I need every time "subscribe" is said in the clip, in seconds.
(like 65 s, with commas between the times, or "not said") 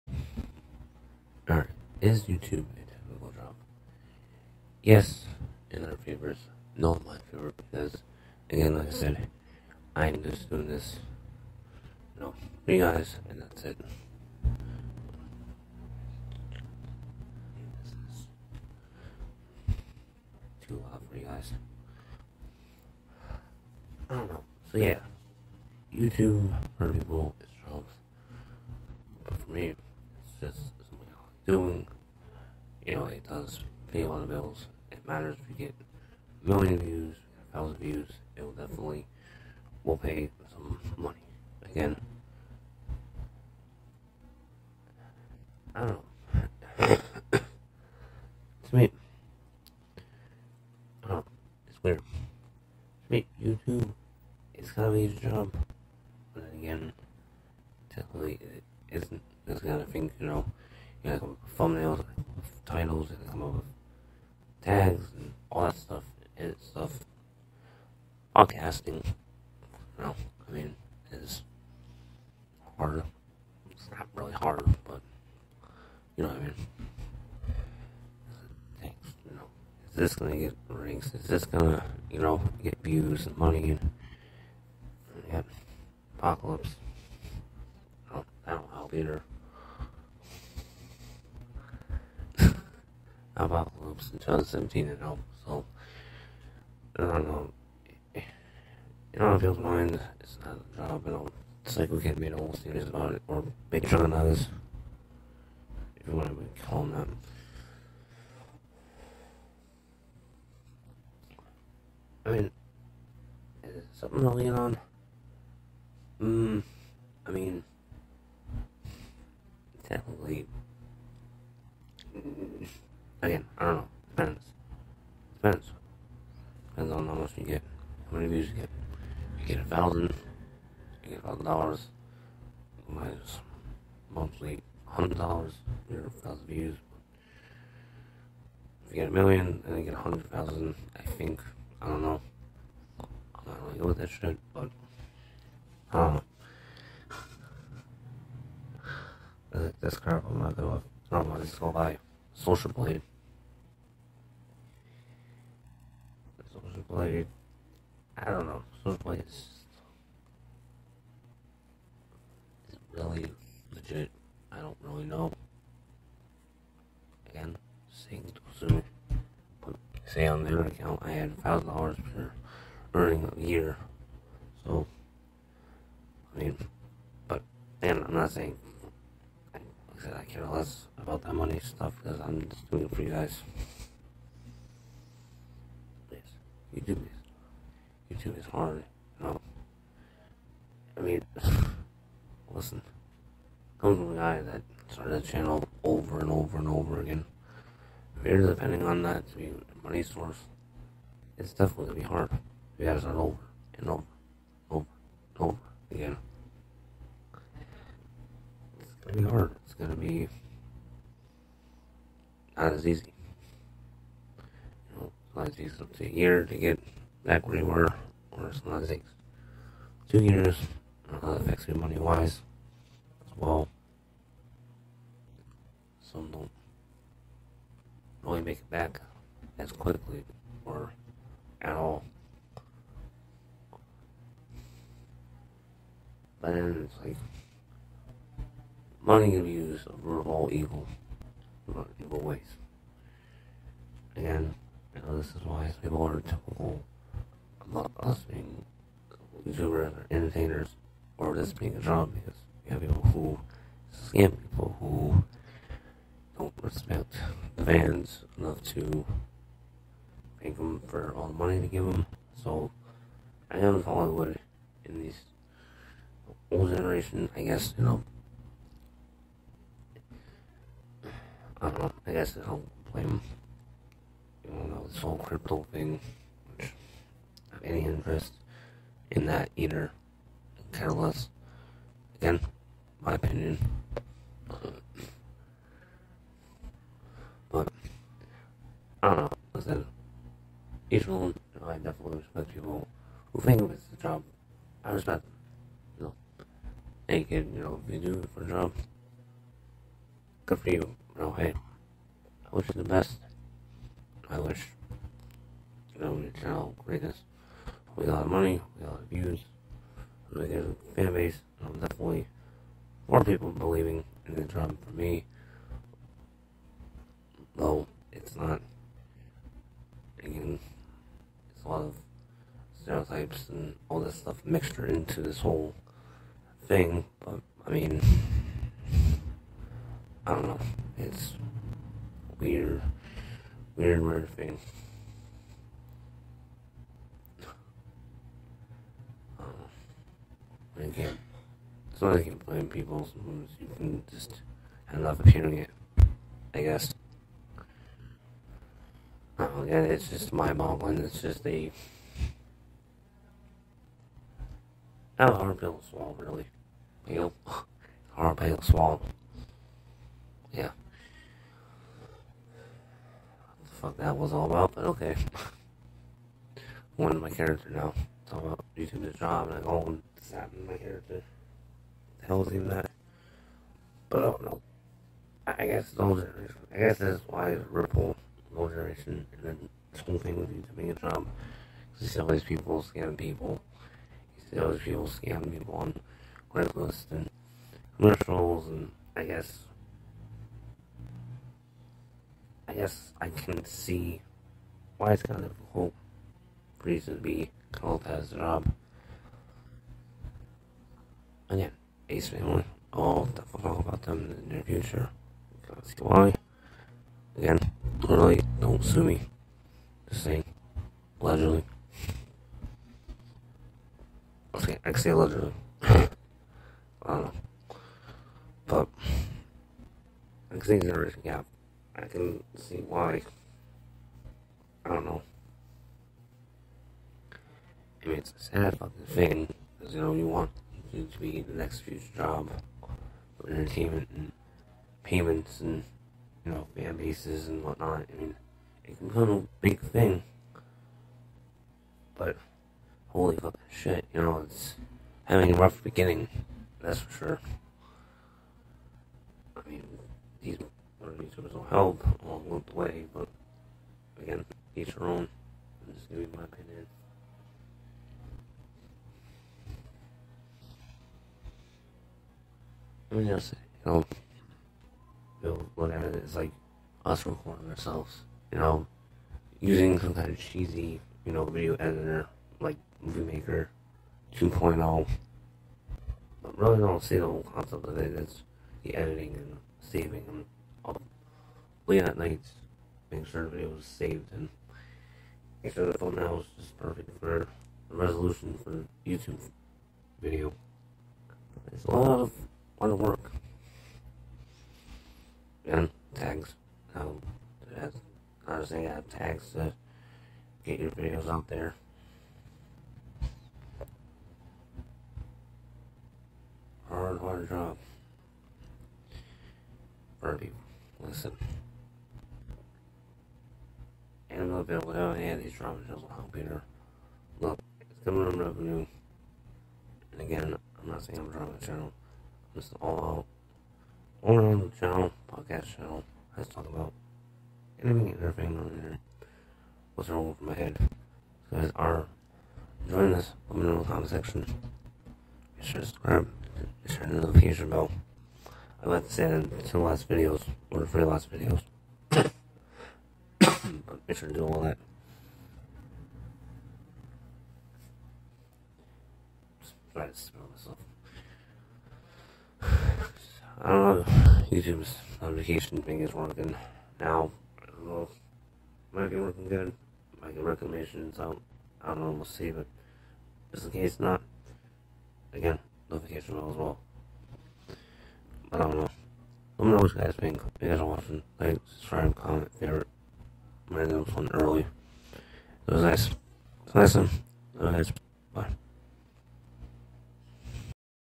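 535 s, 571 s.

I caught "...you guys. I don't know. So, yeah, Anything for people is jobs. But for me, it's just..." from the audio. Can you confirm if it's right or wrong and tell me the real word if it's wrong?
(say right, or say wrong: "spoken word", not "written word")
wrong: "YouTube", not "Anything".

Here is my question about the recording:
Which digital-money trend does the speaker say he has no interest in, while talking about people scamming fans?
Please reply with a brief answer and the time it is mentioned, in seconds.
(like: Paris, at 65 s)
crypto, at 275 s.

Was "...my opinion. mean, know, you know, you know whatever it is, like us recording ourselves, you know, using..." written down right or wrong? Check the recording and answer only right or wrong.
right.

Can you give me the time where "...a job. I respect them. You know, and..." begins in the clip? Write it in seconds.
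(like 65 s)
293 s.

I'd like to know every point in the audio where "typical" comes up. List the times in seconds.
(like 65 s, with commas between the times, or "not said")
246 s.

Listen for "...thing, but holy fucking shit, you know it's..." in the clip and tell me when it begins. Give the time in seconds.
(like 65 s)
439 s.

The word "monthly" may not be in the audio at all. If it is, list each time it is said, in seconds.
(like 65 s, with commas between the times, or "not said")
134 s.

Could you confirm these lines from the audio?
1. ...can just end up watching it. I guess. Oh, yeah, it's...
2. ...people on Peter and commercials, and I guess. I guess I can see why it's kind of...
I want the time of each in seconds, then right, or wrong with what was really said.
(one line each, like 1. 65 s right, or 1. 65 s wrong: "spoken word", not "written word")
1. 343 s wrong: "appearing", not "watching"
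2. 385 s wrong: "Craigslist", not "Peter".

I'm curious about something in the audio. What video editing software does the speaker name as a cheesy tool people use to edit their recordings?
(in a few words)
Movie Maker 2.0.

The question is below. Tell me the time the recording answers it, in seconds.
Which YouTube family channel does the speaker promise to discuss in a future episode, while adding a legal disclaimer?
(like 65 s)
402 s.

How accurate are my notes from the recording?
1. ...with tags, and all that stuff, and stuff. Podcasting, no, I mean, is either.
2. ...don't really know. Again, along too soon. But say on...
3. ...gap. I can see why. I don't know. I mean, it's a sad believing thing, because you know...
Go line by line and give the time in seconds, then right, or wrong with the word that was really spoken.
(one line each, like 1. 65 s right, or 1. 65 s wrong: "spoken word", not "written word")
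1. 63 s wrong: "harder", not "either"
2. 164 s wrong: "seeing", not "along"
3. 421 s wrong: "fucking", not "believing".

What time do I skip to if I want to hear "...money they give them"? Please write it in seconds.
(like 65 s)
261 s.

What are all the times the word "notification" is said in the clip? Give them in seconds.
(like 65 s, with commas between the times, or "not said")
537 s, 555 s, 565 s.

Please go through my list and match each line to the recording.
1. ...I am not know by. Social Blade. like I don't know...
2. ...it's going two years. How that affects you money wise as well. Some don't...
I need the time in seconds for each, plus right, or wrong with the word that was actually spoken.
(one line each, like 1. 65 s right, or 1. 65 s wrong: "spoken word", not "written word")
1. 151 s right
2. 218 s right.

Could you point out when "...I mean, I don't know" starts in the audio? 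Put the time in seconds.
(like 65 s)
327 s.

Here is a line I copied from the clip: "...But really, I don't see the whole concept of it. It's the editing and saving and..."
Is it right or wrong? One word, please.
right.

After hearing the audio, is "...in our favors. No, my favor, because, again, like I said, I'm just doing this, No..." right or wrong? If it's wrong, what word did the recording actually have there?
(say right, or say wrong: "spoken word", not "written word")
right.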